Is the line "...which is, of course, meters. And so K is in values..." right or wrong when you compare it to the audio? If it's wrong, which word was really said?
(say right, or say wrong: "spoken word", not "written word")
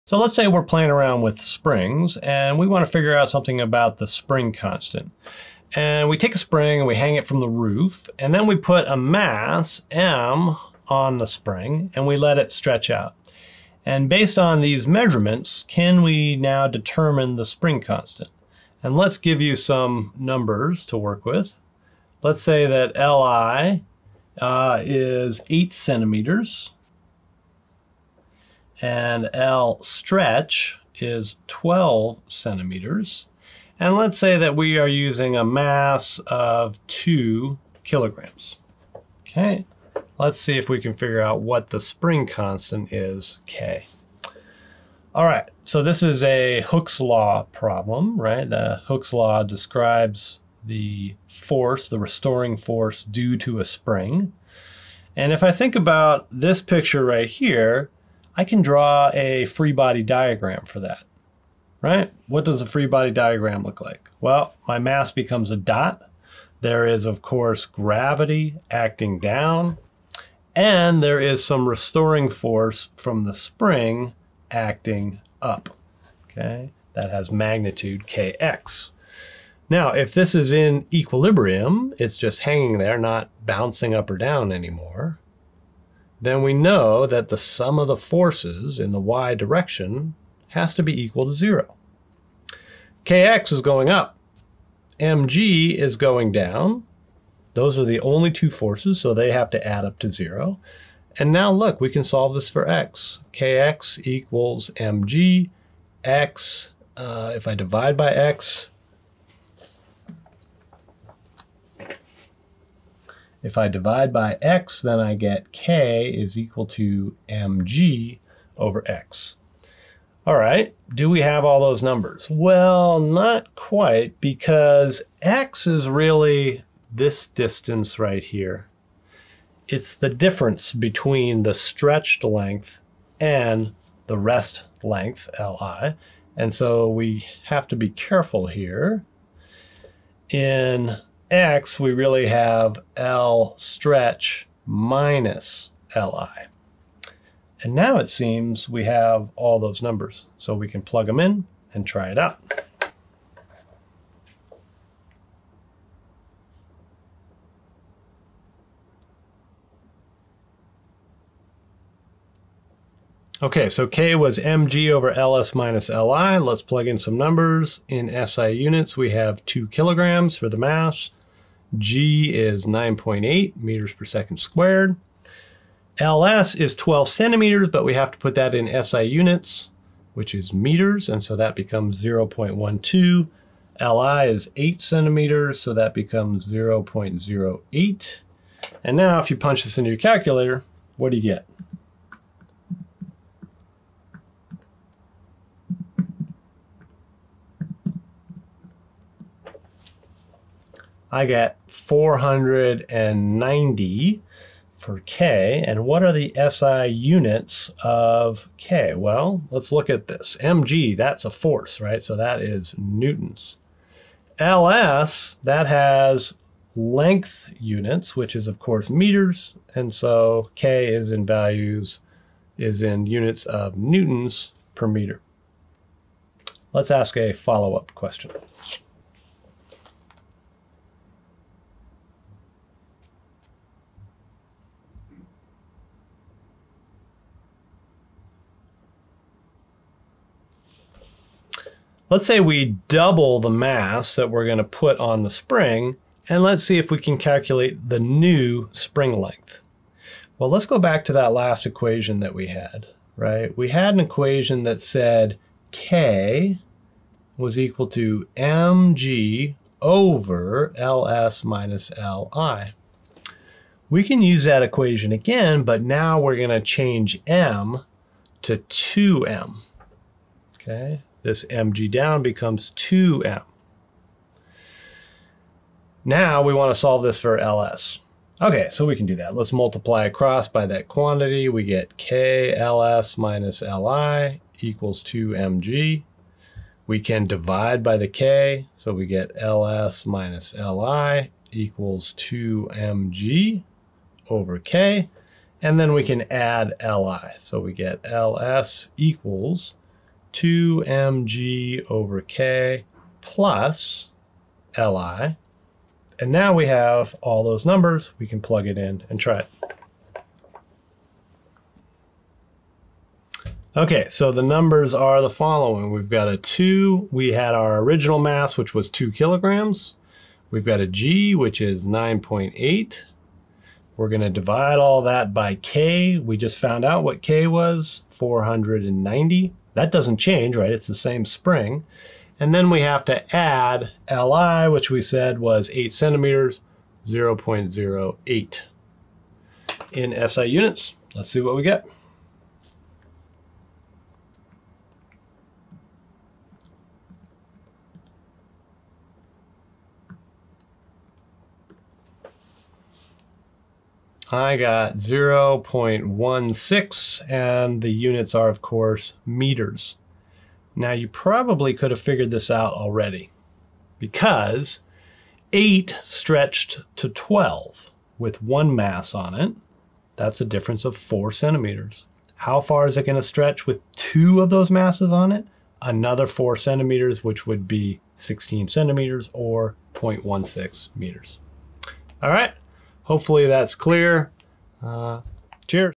right.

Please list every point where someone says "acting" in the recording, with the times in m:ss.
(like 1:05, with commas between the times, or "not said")
1:08, 1:14.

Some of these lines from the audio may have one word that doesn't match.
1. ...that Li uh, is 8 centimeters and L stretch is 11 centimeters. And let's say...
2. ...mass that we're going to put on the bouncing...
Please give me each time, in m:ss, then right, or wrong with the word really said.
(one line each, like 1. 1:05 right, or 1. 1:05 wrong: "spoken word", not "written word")
1. 0:22 wrong: "12", not "11"
2. 4:03 wrong: "spring", not "bouncing".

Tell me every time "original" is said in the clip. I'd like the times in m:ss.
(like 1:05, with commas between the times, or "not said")
5:17.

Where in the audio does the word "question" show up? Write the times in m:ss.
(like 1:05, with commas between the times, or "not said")
3:47.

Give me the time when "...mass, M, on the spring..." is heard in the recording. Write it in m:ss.
0:08.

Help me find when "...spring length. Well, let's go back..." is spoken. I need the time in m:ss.
4:08.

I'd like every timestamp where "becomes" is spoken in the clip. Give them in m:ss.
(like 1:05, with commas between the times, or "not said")
1:05, 3:01, 3:05, 4:32.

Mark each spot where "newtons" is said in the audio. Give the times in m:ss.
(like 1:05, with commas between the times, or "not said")
3:32, 3:43.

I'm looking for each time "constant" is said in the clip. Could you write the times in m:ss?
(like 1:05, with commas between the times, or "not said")
0:04, 0:17, 0:42.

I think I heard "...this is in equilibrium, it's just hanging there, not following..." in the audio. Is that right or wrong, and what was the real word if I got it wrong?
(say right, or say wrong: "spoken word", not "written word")
wrong: "bouncing", not "following".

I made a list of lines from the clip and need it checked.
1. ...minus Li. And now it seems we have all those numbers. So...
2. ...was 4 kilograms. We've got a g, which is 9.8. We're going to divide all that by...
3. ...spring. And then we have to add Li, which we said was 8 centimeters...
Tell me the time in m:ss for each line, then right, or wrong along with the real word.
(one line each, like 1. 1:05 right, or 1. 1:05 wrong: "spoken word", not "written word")
1. 2:24 right
2. 5:18 wrong: "2", not "4"
3. 5:31 right.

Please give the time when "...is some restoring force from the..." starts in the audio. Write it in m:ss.
1:11.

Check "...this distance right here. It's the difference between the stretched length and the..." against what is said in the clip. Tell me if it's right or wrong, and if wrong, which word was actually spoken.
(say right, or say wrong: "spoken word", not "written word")
right.